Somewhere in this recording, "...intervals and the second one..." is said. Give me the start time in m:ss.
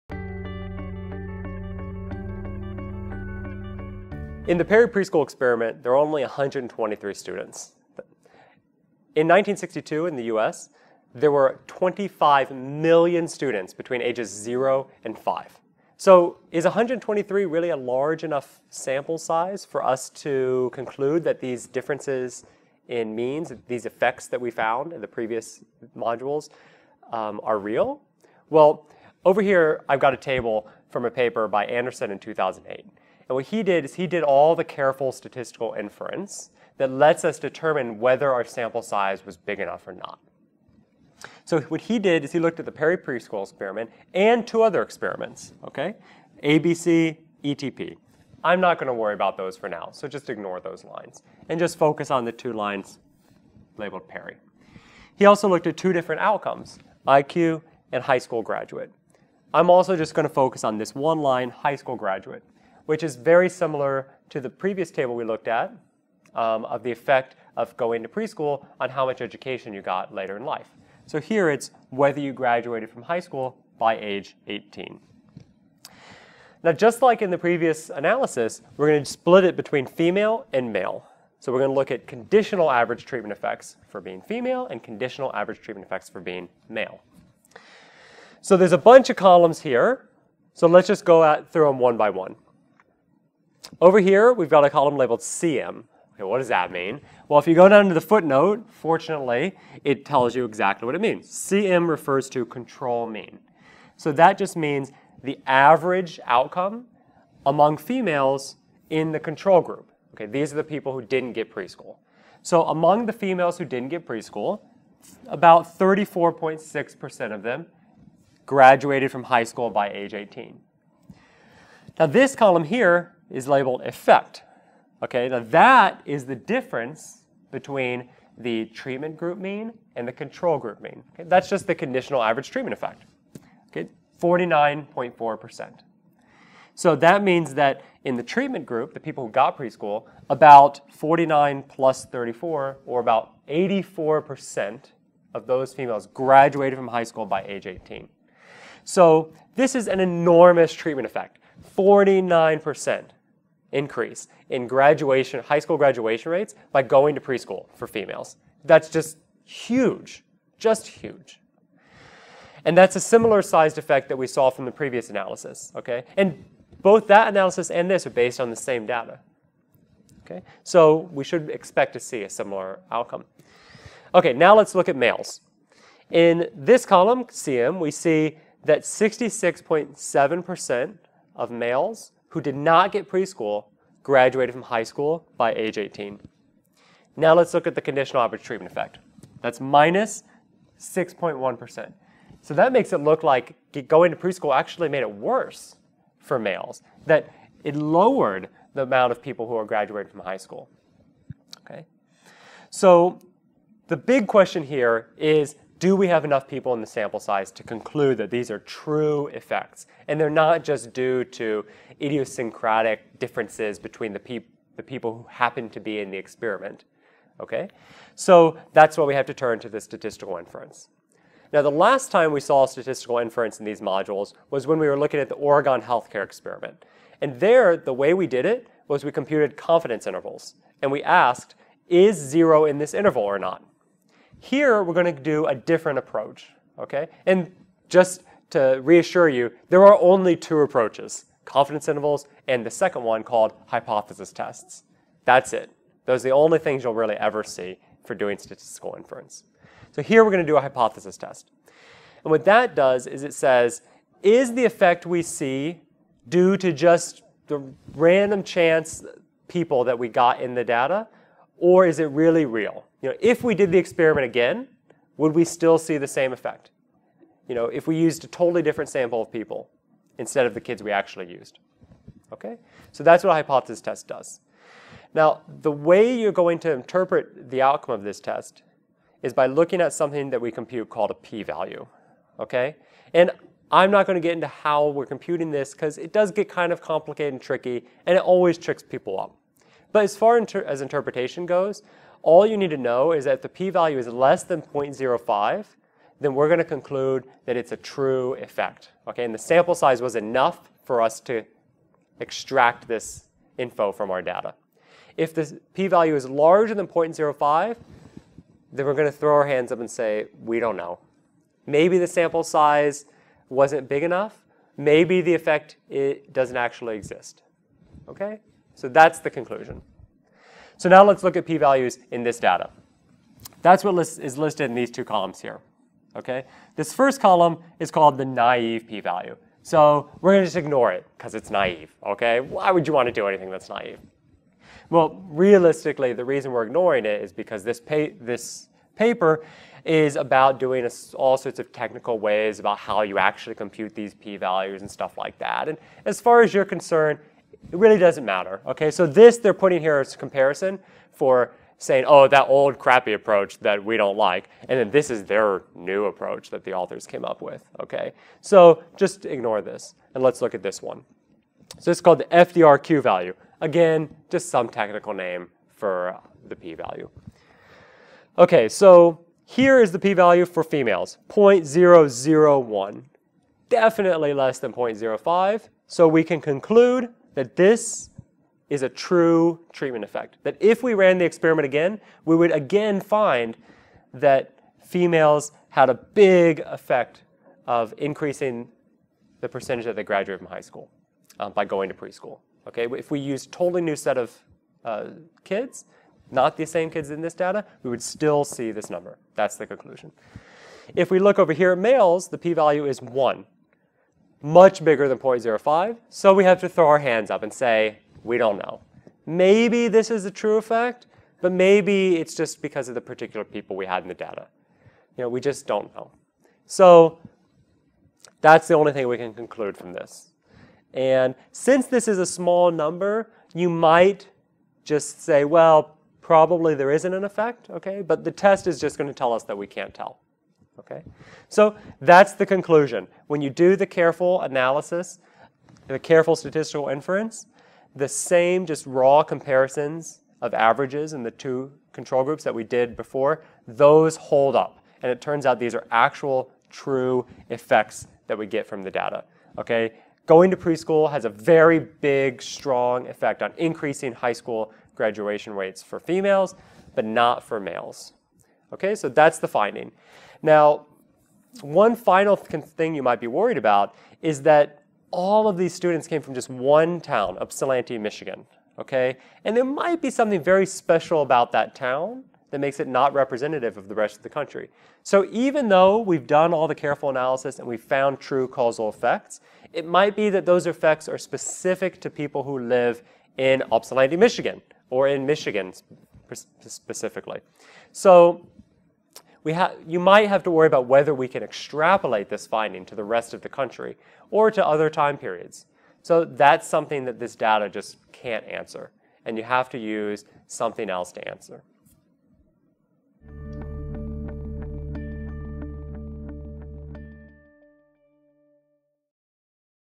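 4:01.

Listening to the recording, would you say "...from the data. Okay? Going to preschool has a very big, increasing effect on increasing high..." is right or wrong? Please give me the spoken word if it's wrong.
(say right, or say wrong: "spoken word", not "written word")
wrong: "strong", not "increasing".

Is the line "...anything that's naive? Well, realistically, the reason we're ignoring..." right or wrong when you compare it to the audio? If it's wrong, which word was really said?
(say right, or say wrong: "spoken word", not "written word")
right.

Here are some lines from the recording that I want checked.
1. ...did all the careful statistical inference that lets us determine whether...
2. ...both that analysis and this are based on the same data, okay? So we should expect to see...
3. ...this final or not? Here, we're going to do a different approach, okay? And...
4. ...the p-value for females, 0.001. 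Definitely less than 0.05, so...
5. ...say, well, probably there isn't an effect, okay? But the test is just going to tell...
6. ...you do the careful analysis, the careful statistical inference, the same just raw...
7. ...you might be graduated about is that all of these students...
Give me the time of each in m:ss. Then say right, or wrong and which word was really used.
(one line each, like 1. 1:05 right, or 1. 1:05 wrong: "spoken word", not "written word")
1. 0:34 right
2. 2:46 right
3. 3:52 wrong: "interval", not "final"
4. 6:09 right
5. 7:05 right
6. 7:13 right
7. 7:42 wrong: "worried", not "graduated".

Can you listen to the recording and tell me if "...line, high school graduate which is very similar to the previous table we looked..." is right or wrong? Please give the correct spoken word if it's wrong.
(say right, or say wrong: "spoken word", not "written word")
right.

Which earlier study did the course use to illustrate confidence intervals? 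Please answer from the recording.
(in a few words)
Oregon healthcare experiment.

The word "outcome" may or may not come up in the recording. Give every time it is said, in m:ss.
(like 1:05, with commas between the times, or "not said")
0:56, 1:46, 2:52, 4:37.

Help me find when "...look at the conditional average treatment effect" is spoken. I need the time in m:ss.
3:07.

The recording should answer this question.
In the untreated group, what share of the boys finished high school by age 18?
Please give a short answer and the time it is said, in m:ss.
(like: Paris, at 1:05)
66.7%, at 2:58.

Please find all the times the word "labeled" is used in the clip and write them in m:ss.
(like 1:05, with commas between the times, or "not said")
0:53, 1:34, 2:03.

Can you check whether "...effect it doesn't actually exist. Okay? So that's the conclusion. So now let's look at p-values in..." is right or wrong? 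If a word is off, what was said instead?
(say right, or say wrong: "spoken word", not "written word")
right.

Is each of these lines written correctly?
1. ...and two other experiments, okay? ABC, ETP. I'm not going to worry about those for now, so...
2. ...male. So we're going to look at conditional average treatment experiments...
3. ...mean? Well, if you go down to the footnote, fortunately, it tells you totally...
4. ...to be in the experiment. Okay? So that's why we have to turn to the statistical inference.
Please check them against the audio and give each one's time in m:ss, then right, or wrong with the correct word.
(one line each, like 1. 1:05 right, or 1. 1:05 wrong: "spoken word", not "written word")
1. 0:44 right
2. 1:20 wrong: "effects", not "experiments"
3. 1:36 wrong: "exactly", not "totally"
4. 3:35 right.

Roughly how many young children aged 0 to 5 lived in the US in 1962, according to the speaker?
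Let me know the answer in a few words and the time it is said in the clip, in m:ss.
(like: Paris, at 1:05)
25 million, at 0:11.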